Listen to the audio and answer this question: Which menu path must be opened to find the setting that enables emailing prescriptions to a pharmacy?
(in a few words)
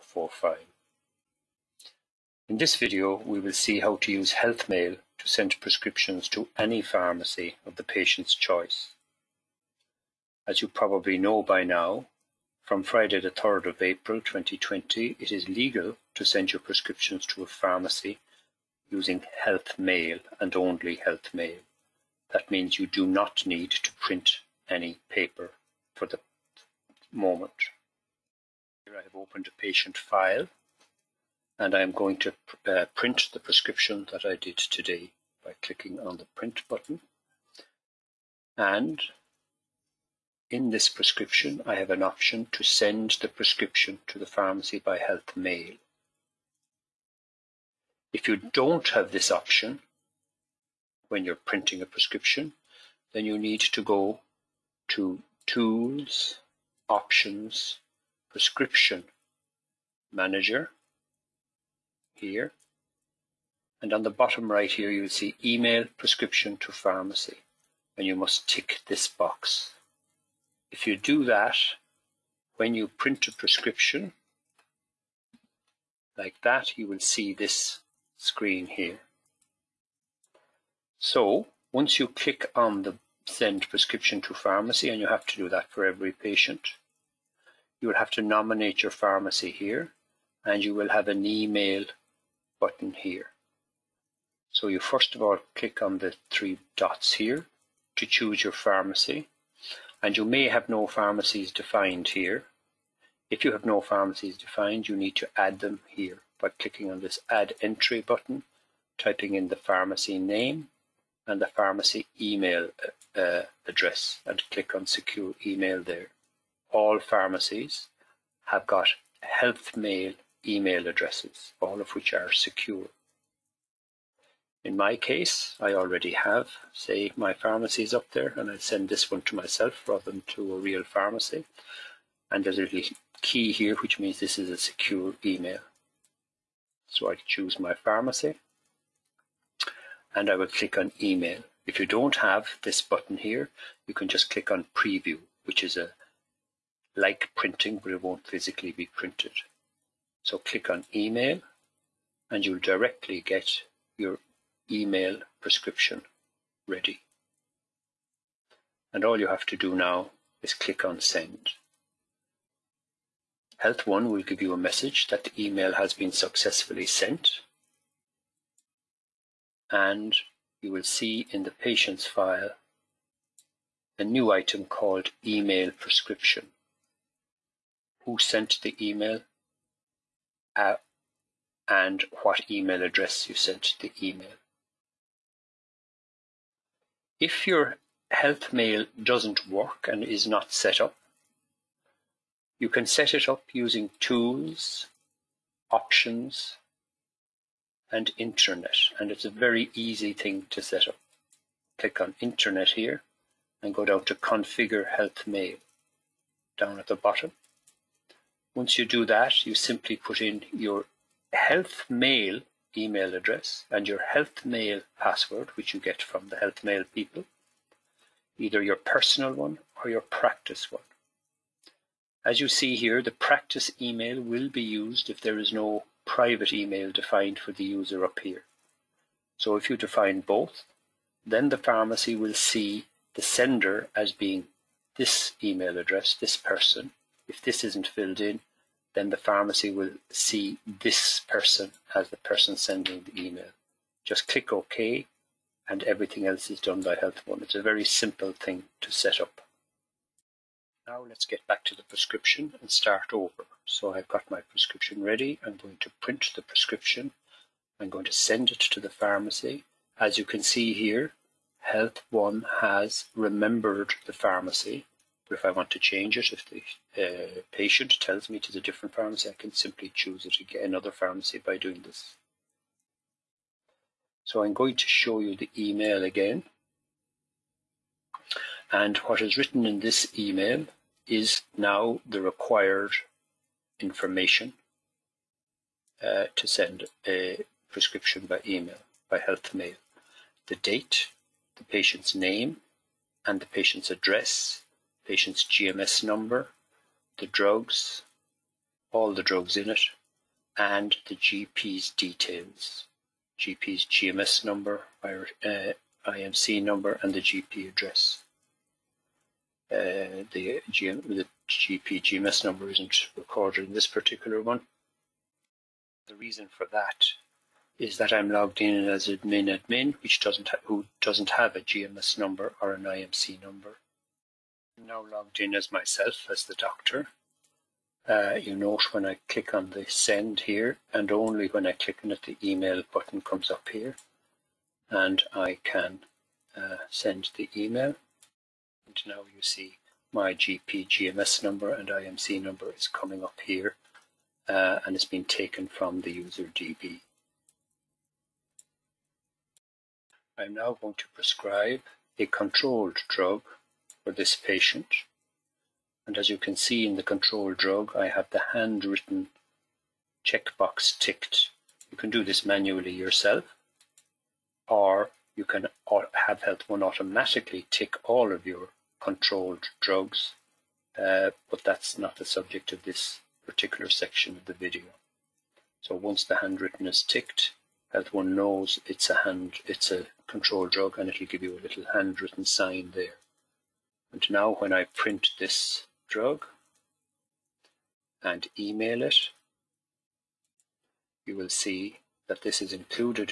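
Tools, Options, Prescription Manager.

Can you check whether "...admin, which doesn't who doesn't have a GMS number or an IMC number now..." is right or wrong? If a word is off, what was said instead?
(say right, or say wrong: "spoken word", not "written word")
right.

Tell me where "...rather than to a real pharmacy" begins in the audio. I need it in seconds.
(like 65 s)
129 s.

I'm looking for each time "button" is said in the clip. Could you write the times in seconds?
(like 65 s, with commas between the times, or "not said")
36 s, 92 s, 108 s, 142 s, 332 s.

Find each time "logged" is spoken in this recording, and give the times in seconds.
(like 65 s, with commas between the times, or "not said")
318 s, 325 s.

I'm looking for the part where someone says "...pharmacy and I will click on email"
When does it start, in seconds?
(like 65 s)
137 s.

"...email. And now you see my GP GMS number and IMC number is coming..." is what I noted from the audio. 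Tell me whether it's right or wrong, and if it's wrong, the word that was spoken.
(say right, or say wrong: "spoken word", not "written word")
right.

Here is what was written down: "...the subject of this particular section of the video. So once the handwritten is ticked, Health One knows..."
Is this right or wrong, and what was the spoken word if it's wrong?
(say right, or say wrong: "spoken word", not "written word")
right.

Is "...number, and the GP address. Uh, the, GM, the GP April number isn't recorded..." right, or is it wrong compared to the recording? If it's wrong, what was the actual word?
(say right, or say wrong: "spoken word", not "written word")
wrong: "GMS", not "April".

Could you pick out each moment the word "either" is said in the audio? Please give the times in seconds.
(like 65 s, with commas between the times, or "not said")
218 s.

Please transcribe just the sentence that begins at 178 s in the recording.
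Who sent the email uh, and what email address you sent the email.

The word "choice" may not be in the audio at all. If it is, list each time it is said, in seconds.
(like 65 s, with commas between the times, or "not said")
8 s.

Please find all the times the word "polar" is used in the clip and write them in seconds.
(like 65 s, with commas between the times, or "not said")
not said.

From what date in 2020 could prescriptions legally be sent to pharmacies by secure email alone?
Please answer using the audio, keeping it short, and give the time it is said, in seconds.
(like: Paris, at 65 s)
Friday the 3rd of April, at 12 s.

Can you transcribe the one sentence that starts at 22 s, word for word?
That means you do not need to print any paper for the moment.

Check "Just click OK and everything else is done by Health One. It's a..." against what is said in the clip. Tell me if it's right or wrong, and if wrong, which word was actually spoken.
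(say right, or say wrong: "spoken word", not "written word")
right.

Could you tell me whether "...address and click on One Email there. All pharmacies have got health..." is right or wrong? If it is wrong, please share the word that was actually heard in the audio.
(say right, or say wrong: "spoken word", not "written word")
wrong: "Secure", not "One".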